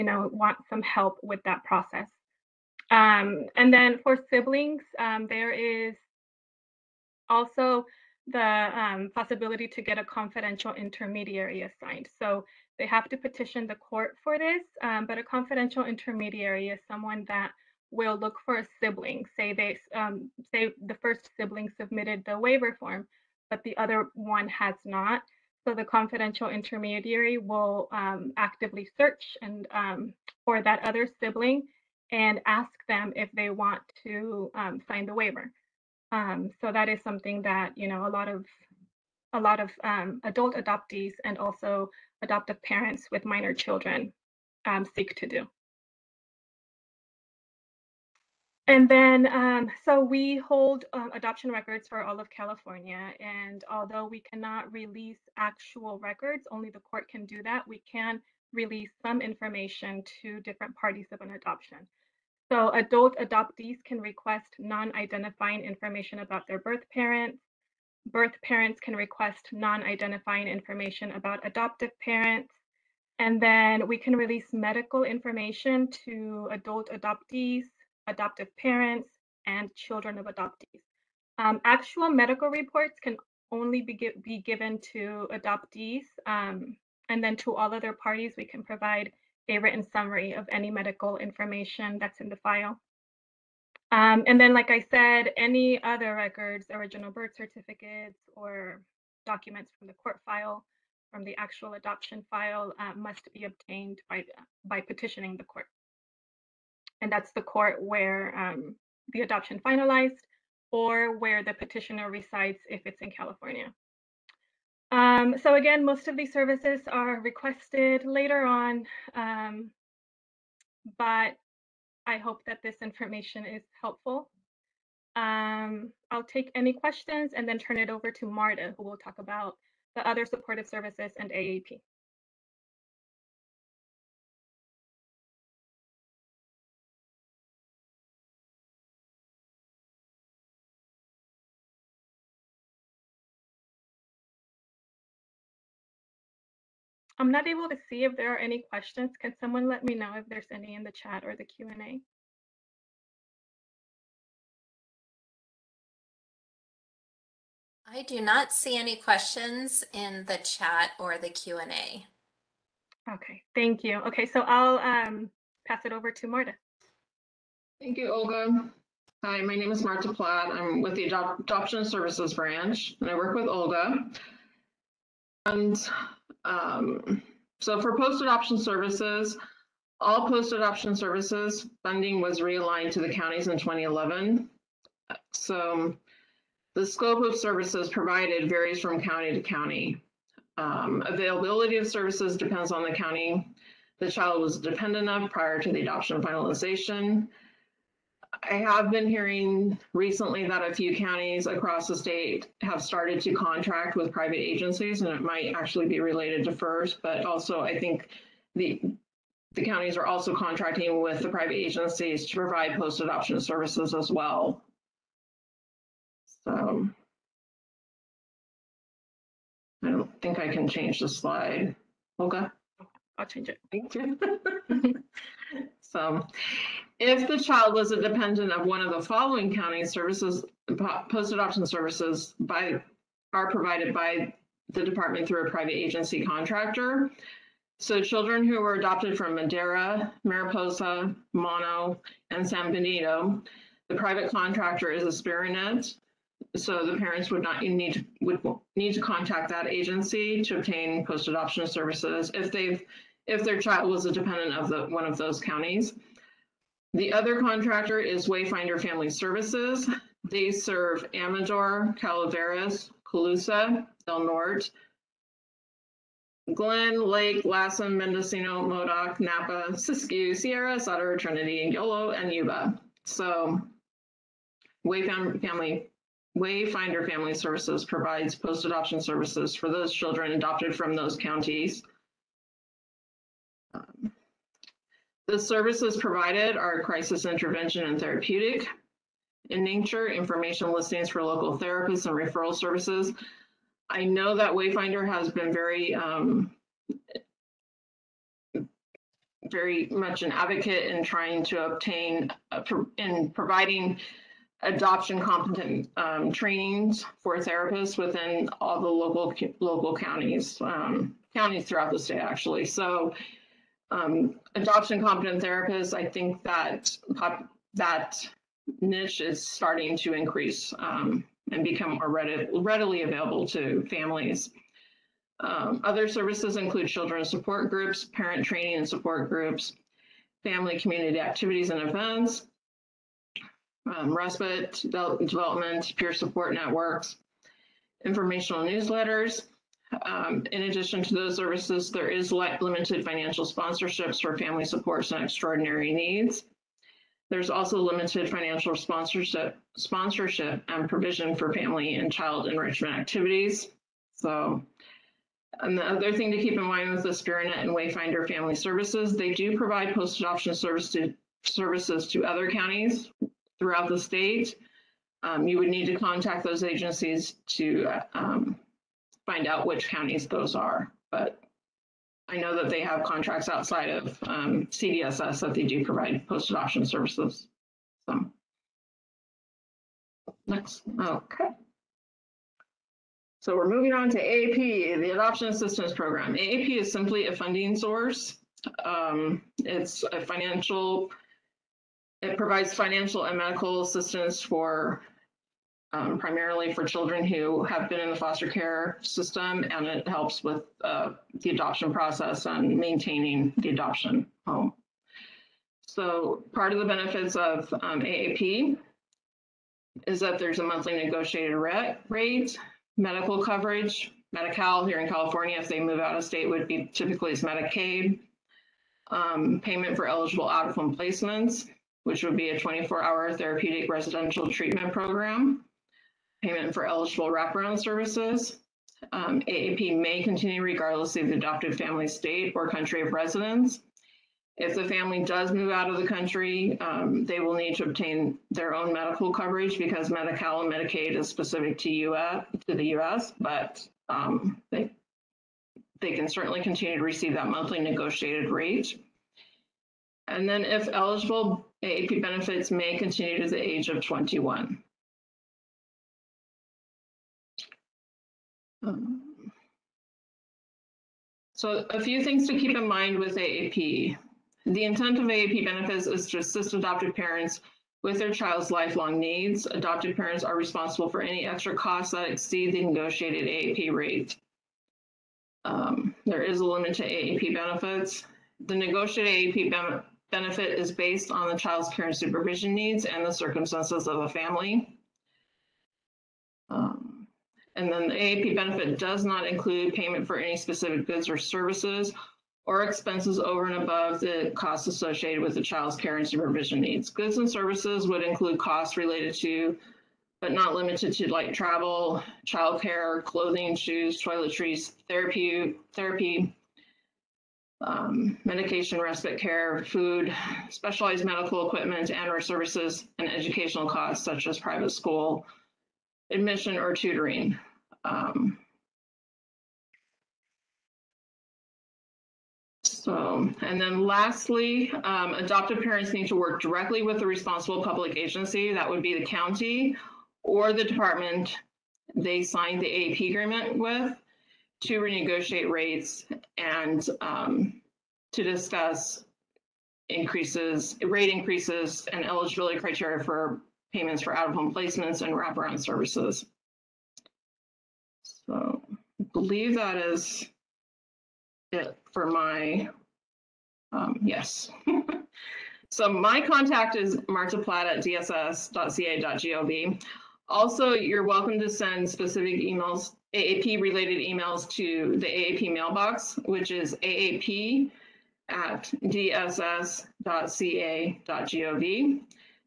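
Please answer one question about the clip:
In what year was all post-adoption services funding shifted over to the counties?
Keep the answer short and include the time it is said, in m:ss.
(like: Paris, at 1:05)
2011, at 3:03.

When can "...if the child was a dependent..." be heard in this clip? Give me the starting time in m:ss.
3:46.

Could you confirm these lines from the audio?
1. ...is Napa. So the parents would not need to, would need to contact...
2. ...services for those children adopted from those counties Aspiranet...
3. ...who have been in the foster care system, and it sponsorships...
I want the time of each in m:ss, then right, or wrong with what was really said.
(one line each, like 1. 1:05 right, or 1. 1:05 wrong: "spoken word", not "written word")
1. 4:04 wrong: "Aspiranet", not "Napa"
2. 4:39 wrong: "The", not "Aspiranet"
3. 6:37 wrong: "helps", not "sponsorships".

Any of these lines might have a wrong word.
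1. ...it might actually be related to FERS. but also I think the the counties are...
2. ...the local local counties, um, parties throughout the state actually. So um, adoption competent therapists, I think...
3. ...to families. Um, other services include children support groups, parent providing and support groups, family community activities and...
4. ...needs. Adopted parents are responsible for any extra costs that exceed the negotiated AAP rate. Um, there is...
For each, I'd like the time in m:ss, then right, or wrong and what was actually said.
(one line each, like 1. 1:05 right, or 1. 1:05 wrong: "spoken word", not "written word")
1. 3:25 right
2. 5:08 wrong: "counties", not "parties"
3. 5:23 wrong: "training", not "providing"
4. 7:49 right.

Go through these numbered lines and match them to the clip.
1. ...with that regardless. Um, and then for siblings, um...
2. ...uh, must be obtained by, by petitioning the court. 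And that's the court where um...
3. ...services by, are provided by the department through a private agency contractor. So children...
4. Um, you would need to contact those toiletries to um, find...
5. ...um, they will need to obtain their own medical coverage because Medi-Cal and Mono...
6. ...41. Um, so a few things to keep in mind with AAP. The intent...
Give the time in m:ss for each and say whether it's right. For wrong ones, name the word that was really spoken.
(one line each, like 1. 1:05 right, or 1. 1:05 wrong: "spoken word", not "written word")
1. 0:01 wrong: "process", not "regardless"
2. 1:42 right
3. 3:51 right
4. 6:05 wrong: "agencies", not "toiletries"
5. 7:16 wrong: "Medicaid", not "Mono"
6. 7:34 wrong: "21", not "41".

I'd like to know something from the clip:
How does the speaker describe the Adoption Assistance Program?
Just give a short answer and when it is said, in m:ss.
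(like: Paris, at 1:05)
A funding source, at 6:27.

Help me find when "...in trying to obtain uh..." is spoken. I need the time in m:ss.
5:00.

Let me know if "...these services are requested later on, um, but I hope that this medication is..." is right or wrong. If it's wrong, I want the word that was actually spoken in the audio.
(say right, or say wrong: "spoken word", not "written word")
wrong: "information", not "medication".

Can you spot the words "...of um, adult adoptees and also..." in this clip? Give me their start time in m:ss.
0:39.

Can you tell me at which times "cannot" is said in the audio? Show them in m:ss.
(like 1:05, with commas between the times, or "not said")
0:54.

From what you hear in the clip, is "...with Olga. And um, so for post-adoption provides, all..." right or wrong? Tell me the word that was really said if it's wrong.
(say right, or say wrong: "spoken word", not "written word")
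wrong: "services", not "provides".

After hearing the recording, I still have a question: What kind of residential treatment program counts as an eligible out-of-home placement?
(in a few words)
24-hour therapeutic.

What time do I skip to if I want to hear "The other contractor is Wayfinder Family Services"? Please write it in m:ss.
4:16.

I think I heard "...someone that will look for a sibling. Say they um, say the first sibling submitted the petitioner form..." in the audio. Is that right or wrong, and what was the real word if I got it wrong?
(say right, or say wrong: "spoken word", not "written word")
wrong: "waiver", not "petitioner".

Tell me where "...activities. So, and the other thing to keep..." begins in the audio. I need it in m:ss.
5:52.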